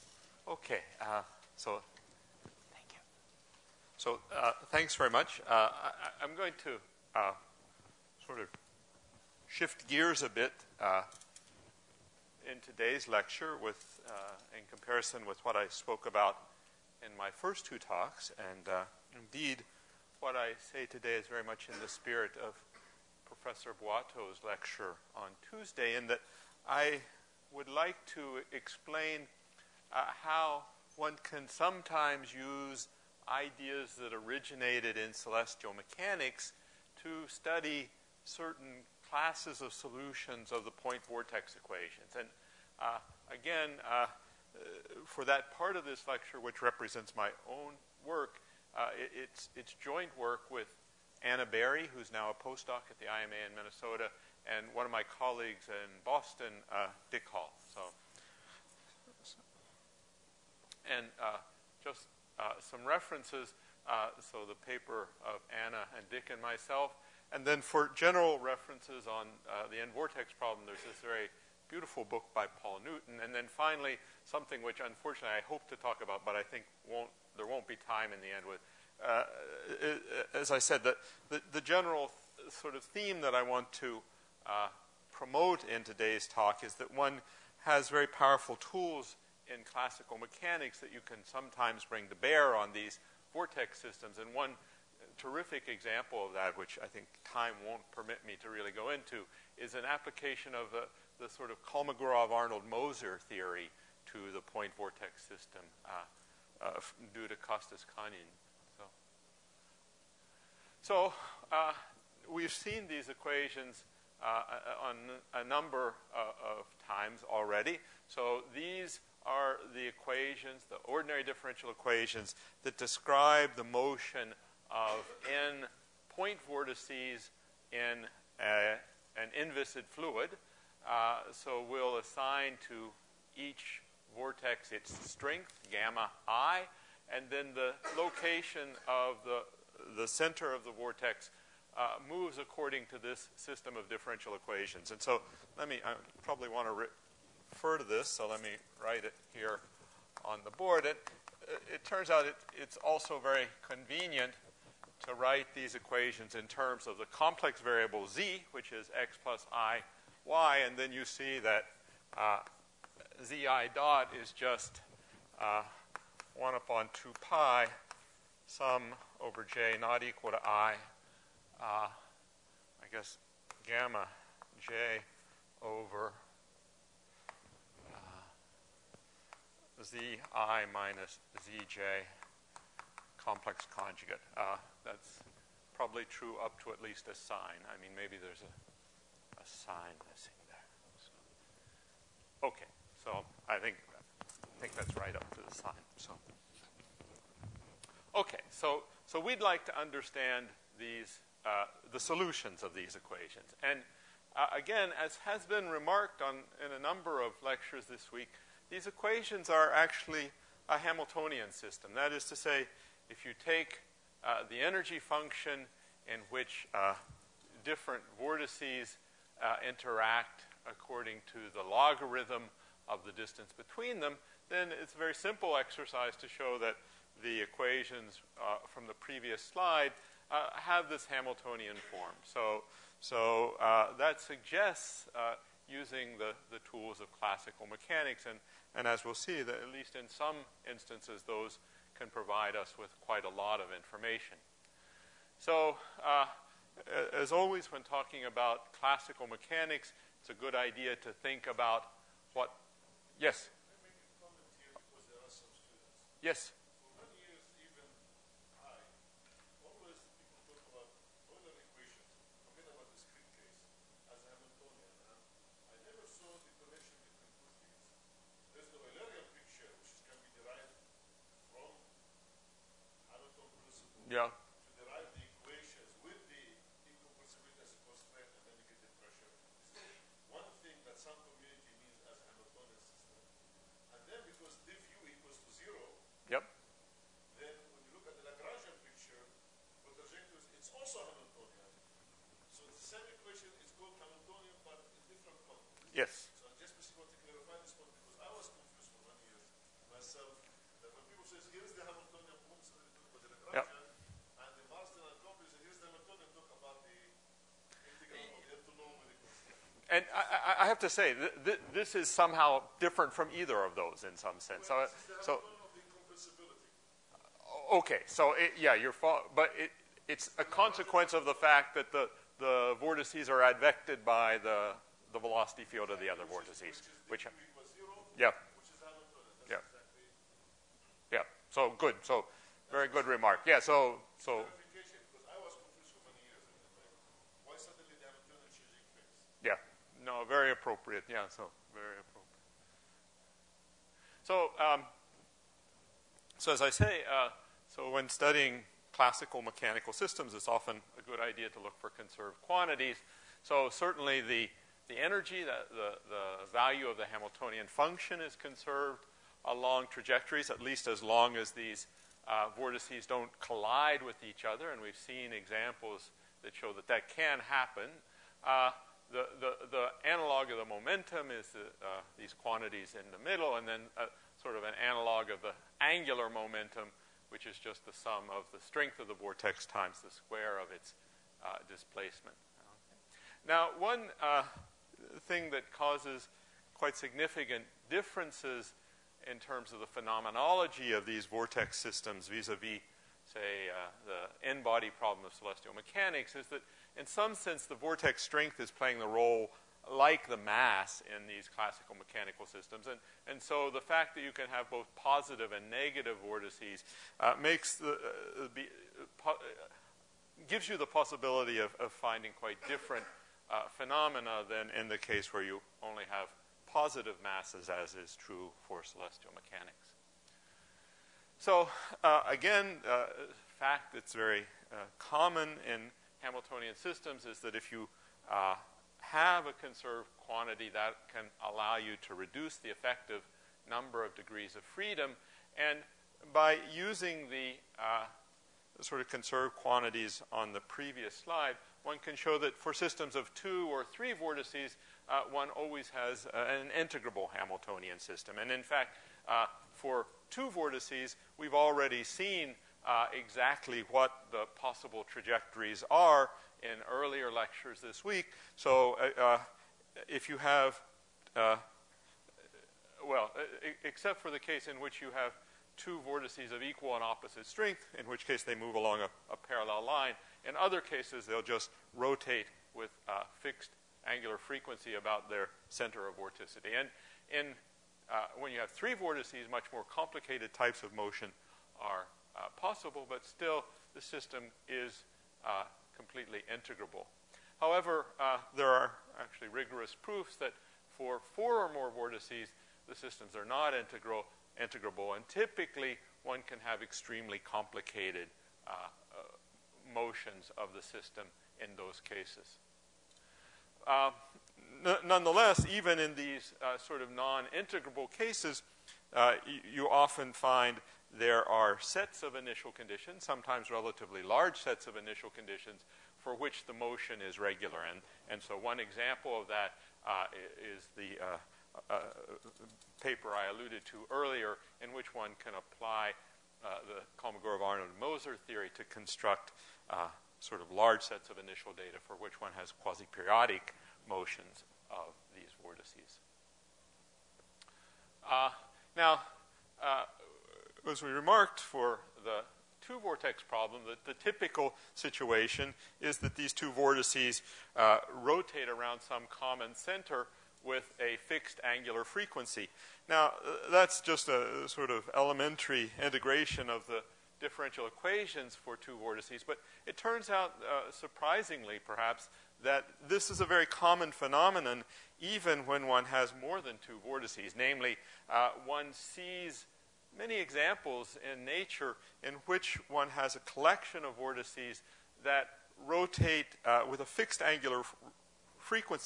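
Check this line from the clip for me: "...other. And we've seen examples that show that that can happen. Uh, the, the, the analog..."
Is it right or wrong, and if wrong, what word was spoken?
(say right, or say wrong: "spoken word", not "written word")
right.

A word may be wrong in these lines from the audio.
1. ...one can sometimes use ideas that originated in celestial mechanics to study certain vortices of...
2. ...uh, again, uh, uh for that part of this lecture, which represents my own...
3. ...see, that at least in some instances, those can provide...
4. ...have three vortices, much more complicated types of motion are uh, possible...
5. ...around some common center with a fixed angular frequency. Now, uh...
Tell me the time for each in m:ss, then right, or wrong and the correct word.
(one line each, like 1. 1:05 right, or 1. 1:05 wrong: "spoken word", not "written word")
1. 0:30 wrong: "classes", not "vortices"
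2. 0:42 right
3. 3:59 right
4. 7:58 right
5. 9:08 right.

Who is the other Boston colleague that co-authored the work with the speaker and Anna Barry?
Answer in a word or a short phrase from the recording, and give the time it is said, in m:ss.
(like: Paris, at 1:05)
Dick Hall, at 0:57.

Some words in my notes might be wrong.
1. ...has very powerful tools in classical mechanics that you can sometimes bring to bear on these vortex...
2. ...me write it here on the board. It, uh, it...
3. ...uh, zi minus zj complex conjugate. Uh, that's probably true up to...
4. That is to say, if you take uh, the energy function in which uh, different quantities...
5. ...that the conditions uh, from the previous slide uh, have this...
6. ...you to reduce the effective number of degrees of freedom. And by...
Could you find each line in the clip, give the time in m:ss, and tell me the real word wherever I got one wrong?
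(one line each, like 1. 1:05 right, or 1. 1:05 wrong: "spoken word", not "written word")
1. 1:27 right
2. 2:28 right
3. 2:57 right
4. 3:31 wrong: "vortices", not "quantities"
5. 3:46 wrong: "equations", not "conditions"
6. 7:11 right.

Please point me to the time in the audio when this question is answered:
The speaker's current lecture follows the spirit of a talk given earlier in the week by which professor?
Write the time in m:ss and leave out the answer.
0:23.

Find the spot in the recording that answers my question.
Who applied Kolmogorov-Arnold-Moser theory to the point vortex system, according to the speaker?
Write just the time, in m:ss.
1:47.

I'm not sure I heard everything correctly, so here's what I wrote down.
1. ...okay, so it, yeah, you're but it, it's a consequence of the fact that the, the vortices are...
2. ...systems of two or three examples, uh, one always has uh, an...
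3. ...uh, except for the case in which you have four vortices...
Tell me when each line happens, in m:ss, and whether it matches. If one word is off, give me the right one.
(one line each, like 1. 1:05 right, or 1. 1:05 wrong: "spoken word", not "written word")
1. 5:17 right
2. 7:22 wrong: "vortices", not "examples"
3. 7:43 wrong: "two", not "four".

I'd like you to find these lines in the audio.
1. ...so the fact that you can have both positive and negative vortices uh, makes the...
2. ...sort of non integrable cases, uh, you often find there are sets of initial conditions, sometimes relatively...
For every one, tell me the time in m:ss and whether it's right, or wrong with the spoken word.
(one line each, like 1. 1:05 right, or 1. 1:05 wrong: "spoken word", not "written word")
1. 6:43 right
2. 8:26 right.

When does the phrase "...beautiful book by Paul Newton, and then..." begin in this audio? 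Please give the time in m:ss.
1:11.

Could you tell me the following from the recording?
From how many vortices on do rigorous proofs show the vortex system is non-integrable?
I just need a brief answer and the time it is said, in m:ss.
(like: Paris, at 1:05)
4, at 8:11.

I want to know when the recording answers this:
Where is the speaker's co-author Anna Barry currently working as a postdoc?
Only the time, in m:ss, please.
0:53.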